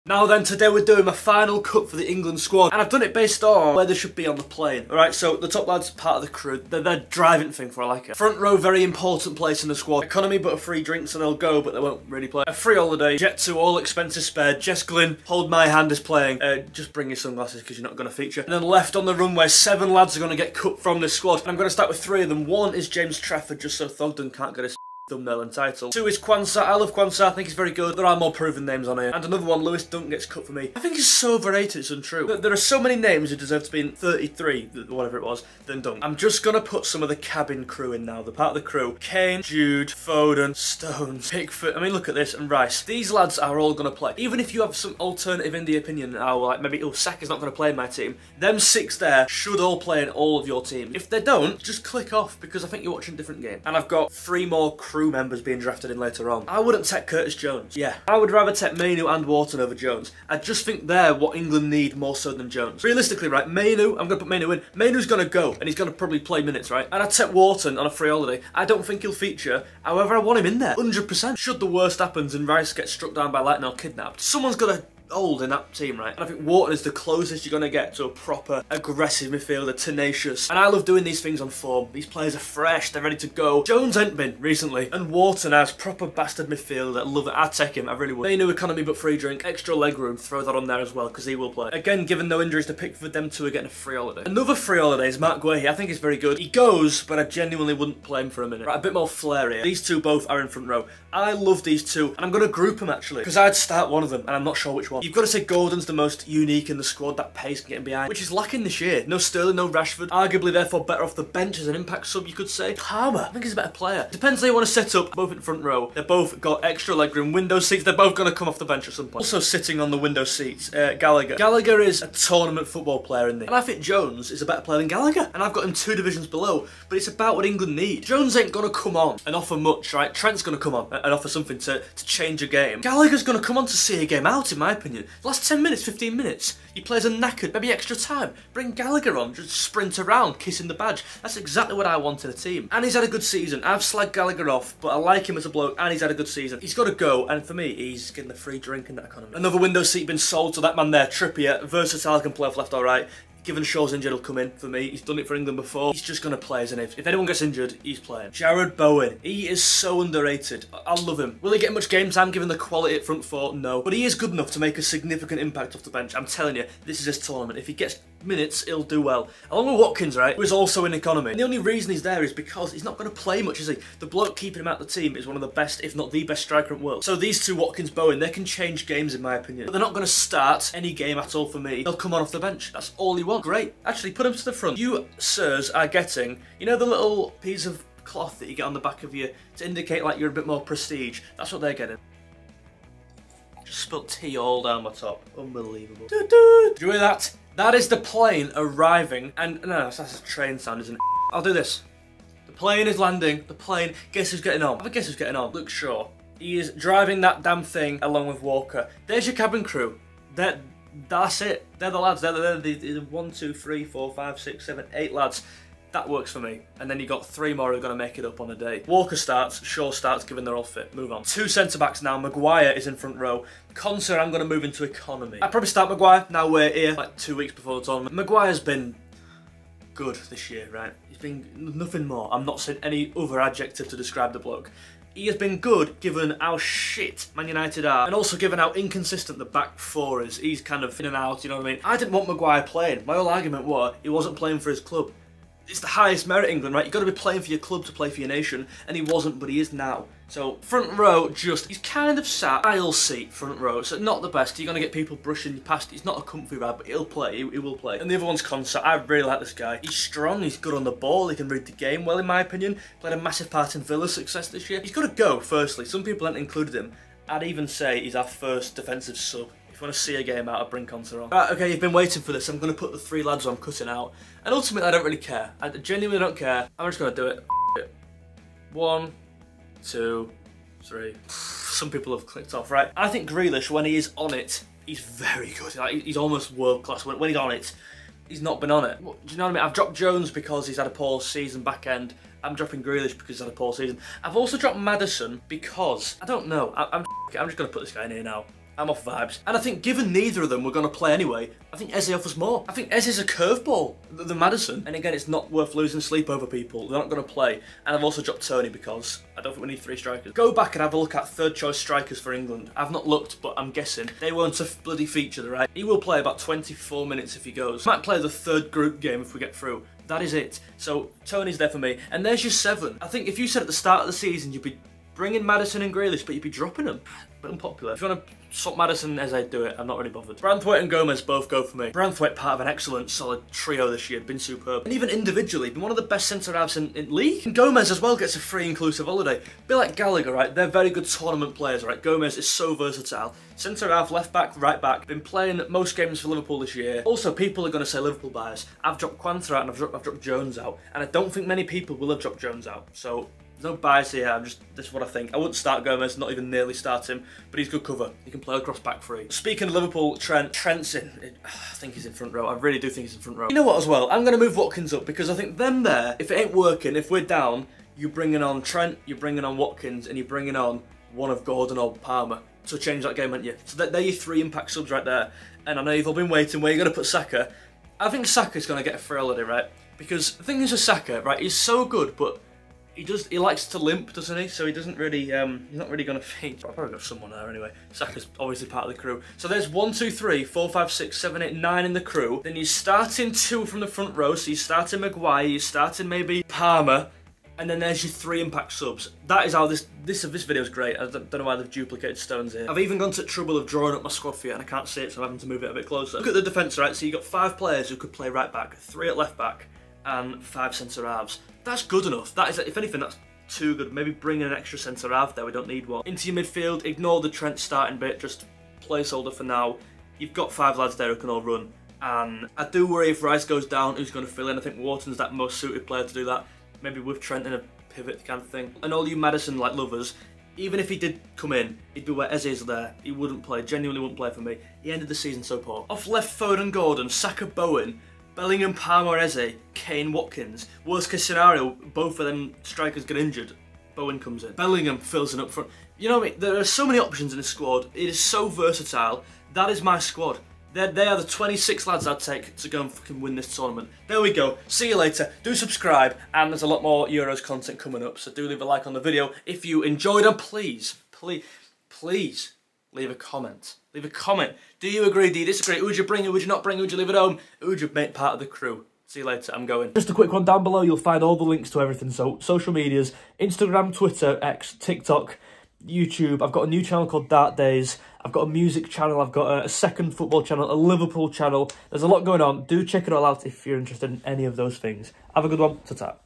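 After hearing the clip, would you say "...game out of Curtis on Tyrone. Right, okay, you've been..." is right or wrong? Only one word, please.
wrong.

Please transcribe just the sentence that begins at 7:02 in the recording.
And I do worry if Rice goes down, who's going to fill in?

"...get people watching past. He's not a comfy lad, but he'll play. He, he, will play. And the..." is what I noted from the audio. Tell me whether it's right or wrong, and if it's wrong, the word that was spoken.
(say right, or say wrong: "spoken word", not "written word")
wrong: "brushing", not "watching".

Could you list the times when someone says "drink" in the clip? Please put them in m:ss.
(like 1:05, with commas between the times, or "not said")
0:10, 1:29, 2:28.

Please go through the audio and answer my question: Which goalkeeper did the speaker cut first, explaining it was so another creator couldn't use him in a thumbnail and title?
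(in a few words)
James Trafford.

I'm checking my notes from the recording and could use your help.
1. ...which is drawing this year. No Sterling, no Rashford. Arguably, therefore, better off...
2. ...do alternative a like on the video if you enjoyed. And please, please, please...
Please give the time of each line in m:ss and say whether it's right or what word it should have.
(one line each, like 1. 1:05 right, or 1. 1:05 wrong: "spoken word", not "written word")
1. 1:48 wrong: "lacking", not "drawing"
2. 7:38 wrong: "leave", not "alternative".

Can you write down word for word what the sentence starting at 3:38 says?
Walker starts, Shaw starts, given they're all fit.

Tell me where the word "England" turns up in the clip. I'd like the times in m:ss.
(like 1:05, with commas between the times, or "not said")
0:02, 1:01, 2:07, 2:35, 4:06, 5:12.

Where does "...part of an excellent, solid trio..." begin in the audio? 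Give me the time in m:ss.
5:32.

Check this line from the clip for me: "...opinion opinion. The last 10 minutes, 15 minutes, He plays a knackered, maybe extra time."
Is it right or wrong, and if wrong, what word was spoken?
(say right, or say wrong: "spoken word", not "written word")
right.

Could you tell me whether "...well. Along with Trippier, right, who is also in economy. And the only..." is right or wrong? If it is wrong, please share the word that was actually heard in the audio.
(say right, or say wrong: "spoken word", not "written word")
wrong: "Watkins", not "Trippier".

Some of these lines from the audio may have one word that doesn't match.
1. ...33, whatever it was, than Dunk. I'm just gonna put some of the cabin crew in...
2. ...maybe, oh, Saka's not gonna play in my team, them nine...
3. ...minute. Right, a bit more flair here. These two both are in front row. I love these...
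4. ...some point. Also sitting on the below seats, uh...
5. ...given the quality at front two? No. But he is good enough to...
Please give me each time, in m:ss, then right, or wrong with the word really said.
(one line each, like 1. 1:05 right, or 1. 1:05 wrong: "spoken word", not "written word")
1. 0:33 right
2. 0:46 wrong: "six", not "nine"
3. 1:38 right
4. 1:58 wrong: "window", not "below"
5. 2:42 wrong: "four", not "two".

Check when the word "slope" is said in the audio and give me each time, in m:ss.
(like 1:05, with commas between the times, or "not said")
not said.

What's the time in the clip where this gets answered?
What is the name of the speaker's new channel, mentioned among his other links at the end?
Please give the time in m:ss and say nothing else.
7:57.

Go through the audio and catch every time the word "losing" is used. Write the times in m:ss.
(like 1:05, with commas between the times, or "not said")
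5:05.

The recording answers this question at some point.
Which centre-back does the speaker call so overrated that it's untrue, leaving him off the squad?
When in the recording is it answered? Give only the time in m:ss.
0:29.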